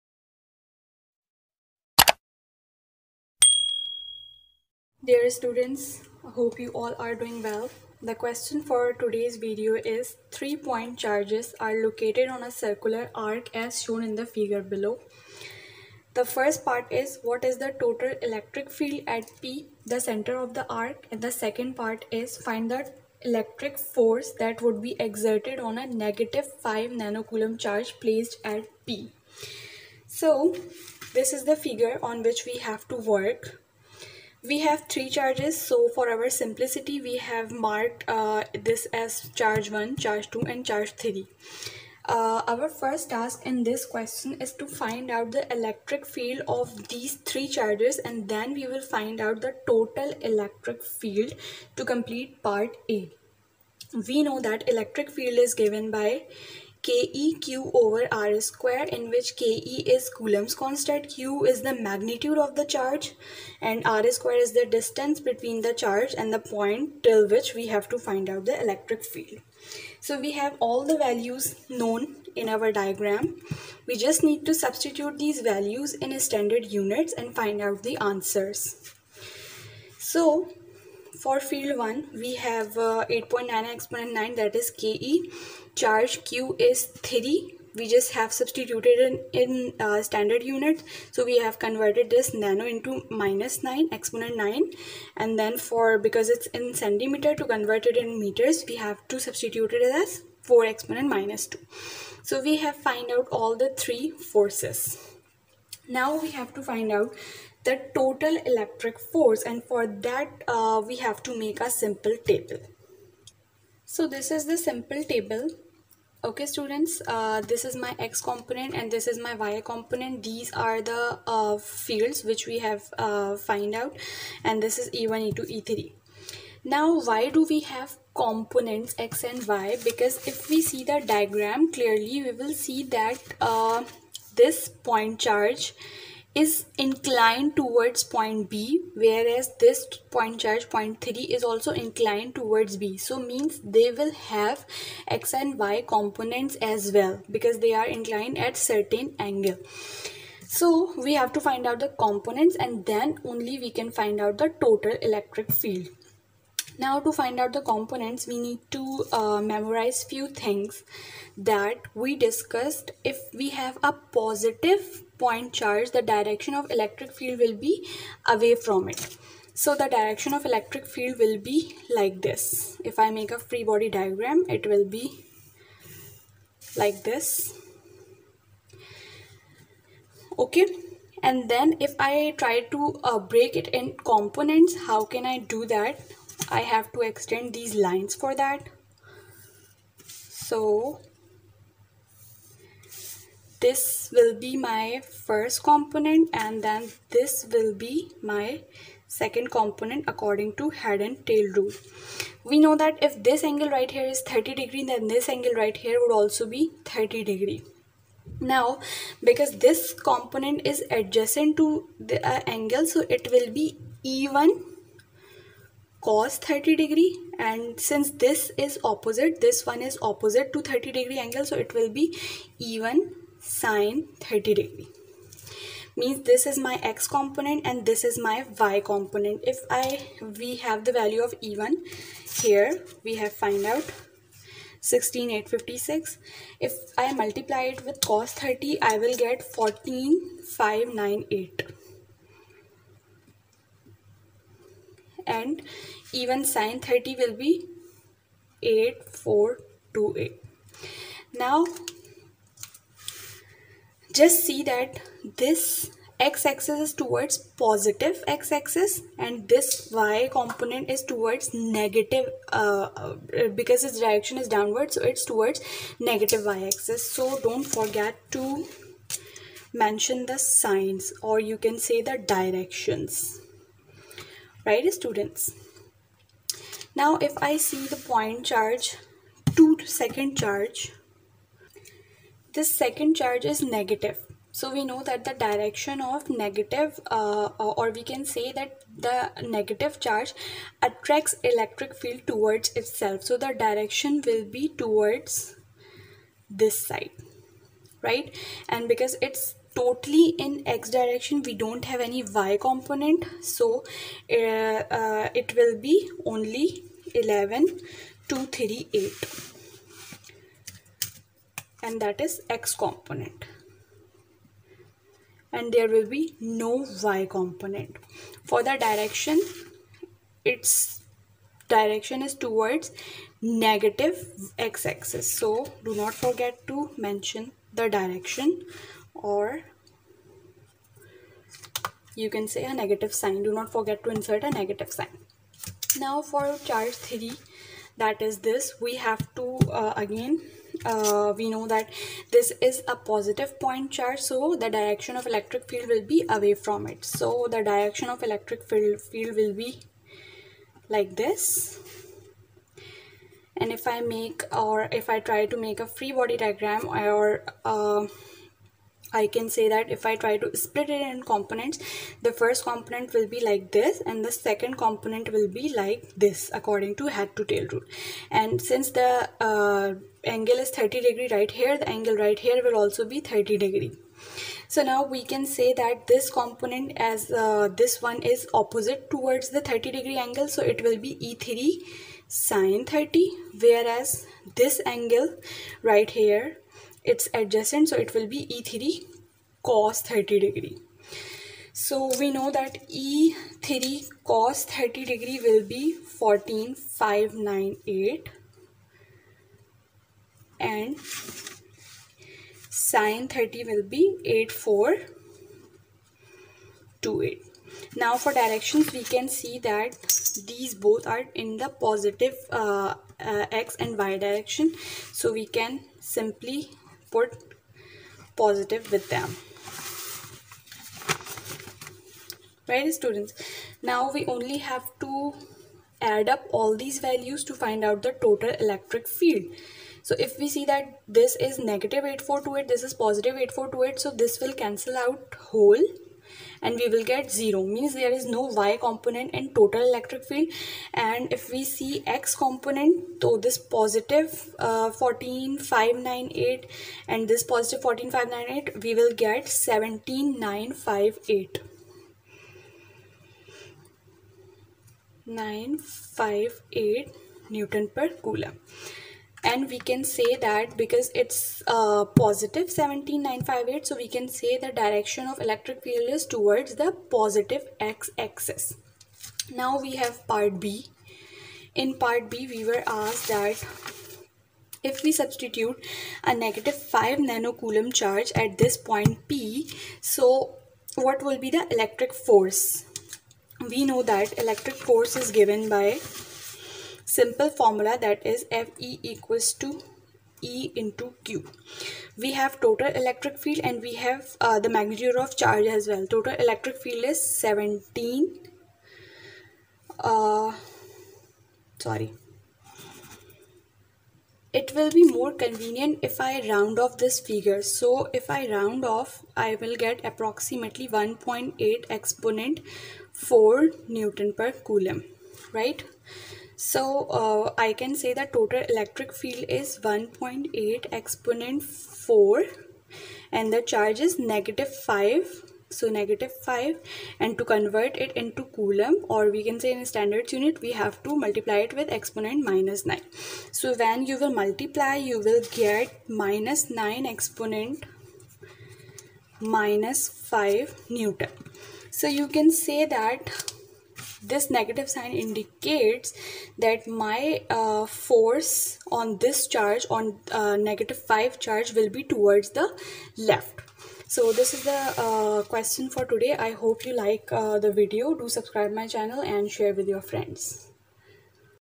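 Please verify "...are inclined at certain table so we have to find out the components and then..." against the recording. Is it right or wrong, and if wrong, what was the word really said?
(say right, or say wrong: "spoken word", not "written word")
wrong: "angle", not "table".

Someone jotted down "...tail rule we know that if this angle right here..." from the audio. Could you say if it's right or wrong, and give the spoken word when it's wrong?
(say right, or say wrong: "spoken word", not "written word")
right.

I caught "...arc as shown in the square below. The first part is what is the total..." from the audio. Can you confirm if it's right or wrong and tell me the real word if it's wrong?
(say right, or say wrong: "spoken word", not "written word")
wrong: "figure", not "square".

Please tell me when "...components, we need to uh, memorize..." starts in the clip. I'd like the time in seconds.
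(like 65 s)
157 s.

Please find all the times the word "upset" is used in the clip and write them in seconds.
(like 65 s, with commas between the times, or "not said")
not said.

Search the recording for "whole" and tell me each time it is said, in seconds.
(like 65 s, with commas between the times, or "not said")
435 s.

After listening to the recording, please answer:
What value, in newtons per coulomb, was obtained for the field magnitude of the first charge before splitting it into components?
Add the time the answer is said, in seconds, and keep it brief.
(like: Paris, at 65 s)
16856, at 233 s.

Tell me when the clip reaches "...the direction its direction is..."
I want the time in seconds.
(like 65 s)
318 s.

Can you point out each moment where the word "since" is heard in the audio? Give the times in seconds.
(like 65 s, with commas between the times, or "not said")
217 s, 368 s.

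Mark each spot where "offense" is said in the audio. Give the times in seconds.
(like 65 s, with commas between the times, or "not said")
not said.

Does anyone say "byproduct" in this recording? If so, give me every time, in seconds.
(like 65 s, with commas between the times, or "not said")
not said.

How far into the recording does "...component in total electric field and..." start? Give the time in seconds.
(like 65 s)
438 s.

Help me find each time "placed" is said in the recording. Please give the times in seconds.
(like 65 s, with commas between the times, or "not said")
27 s.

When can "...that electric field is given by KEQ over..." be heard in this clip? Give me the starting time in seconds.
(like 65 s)
54 s.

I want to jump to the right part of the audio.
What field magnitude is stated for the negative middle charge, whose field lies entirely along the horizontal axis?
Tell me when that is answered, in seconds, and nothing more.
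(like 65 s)
307 s.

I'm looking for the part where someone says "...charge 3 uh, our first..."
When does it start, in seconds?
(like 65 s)
40 s.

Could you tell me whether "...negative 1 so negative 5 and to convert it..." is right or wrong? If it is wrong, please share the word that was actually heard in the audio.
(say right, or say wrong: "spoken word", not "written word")
wrong: "5", not "1".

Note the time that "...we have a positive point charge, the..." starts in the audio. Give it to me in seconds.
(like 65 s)
163 s.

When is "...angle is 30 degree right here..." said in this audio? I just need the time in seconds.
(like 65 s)
370 s.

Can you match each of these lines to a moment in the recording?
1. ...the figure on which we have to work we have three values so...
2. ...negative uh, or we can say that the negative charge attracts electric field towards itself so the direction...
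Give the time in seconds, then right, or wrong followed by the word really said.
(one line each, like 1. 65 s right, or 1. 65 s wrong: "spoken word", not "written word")
1. 31 s wrong: "charges", not "values"
2. 286 s right.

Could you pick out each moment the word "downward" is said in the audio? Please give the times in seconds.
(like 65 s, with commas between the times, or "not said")
264 s.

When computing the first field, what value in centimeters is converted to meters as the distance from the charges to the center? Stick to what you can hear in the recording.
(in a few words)
4.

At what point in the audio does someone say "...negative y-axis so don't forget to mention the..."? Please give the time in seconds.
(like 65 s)
265 s.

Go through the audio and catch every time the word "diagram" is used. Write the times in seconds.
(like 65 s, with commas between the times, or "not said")
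72 s, 131 s, 173 s, 356 s.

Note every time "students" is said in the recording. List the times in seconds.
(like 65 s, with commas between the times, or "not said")
5 s, 116 s, 274 s, 422 s.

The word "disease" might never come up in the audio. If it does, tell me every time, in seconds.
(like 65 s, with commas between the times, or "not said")
not said.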